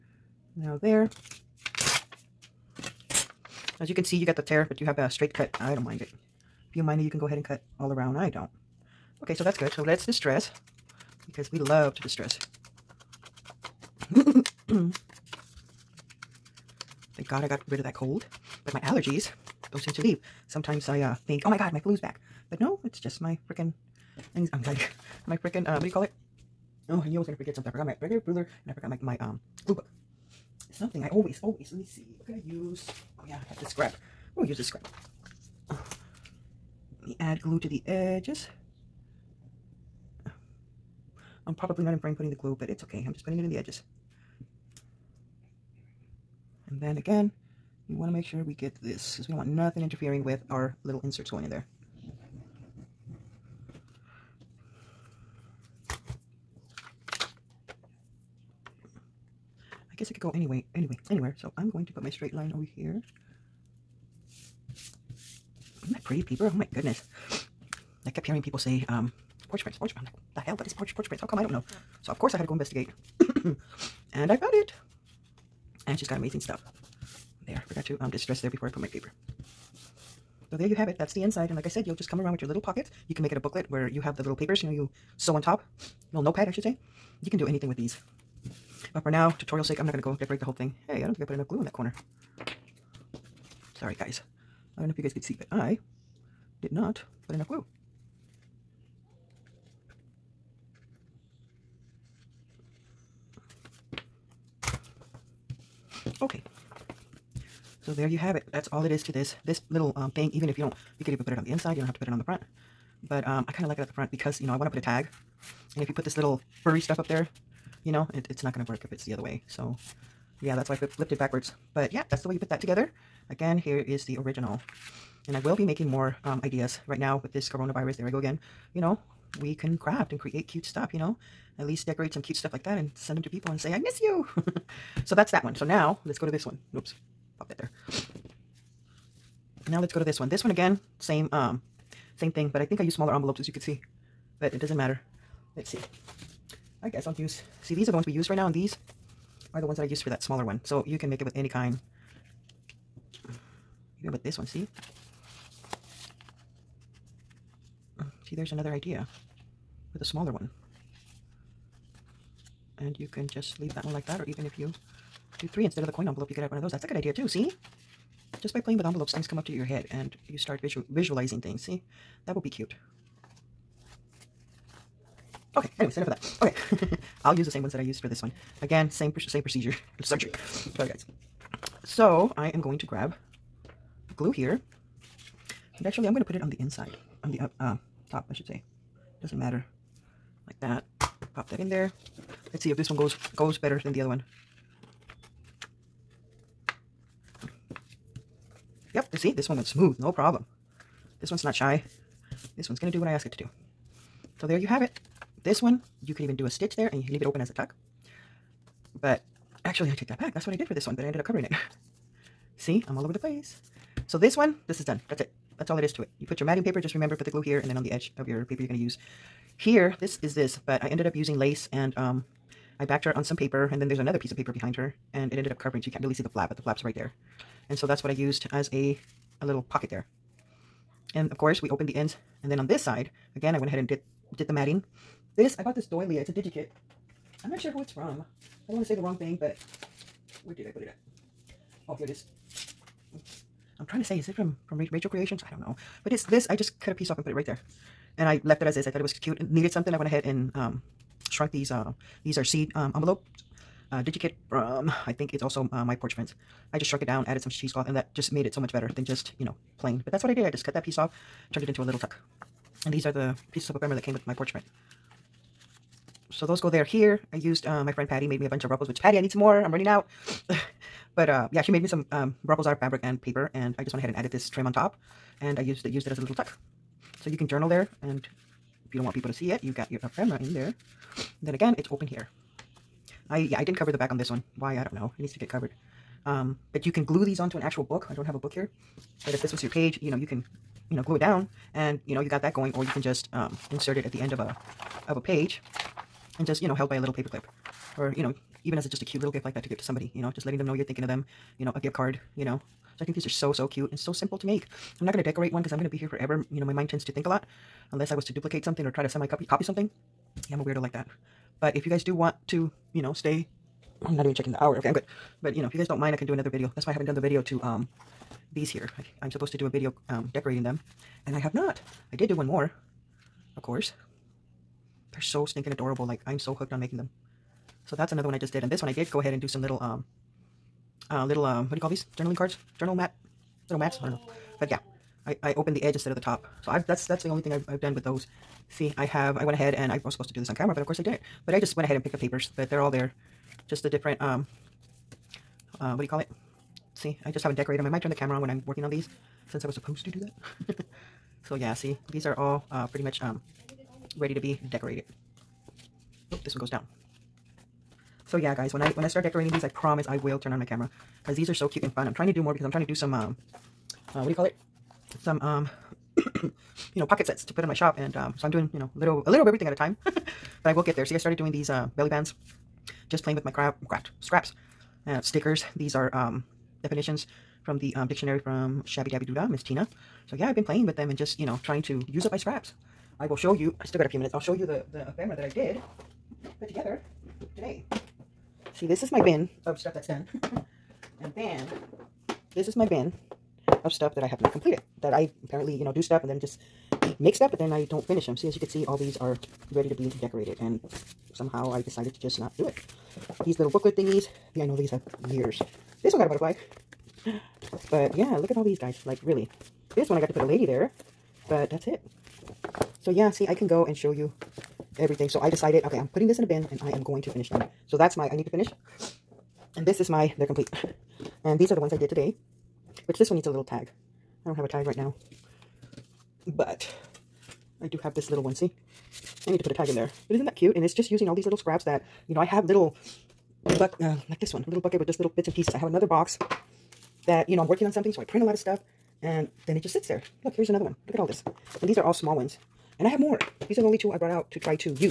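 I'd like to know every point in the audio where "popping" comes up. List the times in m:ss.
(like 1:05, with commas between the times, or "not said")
not said.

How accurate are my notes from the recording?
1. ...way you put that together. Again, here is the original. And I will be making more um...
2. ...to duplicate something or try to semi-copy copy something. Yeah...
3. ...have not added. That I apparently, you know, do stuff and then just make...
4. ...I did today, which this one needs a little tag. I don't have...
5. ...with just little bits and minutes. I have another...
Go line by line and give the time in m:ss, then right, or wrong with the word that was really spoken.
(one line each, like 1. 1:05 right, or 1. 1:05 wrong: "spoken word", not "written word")
1. 2:02 right
2. 5:08 right
3. 6:34 wrong: "completed", not "added"
4. 7:01 right
5. 7:14 wrong: "pieces", not "minutes".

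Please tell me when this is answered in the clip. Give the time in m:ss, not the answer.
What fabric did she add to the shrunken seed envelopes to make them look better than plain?
4:17.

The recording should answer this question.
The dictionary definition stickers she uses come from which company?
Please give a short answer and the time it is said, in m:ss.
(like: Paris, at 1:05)
Shabby Dabby Doodah, at 6:18.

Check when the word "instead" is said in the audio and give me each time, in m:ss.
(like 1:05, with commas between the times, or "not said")
2:45, 5:35.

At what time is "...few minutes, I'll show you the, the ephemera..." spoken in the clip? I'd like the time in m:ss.
6:24.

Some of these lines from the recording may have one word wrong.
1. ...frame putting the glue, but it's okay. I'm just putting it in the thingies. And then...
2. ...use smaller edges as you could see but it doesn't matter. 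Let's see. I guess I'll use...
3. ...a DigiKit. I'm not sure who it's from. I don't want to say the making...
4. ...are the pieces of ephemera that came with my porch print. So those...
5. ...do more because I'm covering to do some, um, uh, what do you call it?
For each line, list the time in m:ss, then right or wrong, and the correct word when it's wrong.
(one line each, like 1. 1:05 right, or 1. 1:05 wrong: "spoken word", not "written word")
1. 0:41 wrong: "edges", not "thingies"
2. 2:22 wrong: "envelopes", not "edges"
3. 3:56 wrong: "wrong", not "making"
4. 4:23 right
5. 6:02 wrong: "trying", not "covering".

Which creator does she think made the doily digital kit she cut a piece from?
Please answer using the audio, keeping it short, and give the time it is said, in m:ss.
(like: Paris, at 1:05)
Rachel Creations, at 4:04.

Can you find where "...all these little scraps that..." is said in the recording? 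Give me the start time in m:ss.
7:11.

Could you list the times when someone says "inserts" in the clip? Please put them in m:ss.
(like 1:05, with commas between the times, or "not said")
0:51, 4:53.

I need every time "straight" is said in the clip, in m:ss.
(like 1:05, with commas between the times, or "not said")
0:05, 1:02.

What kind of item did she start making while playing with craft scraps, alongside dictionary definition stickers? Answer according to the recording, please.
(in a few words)
belly bands.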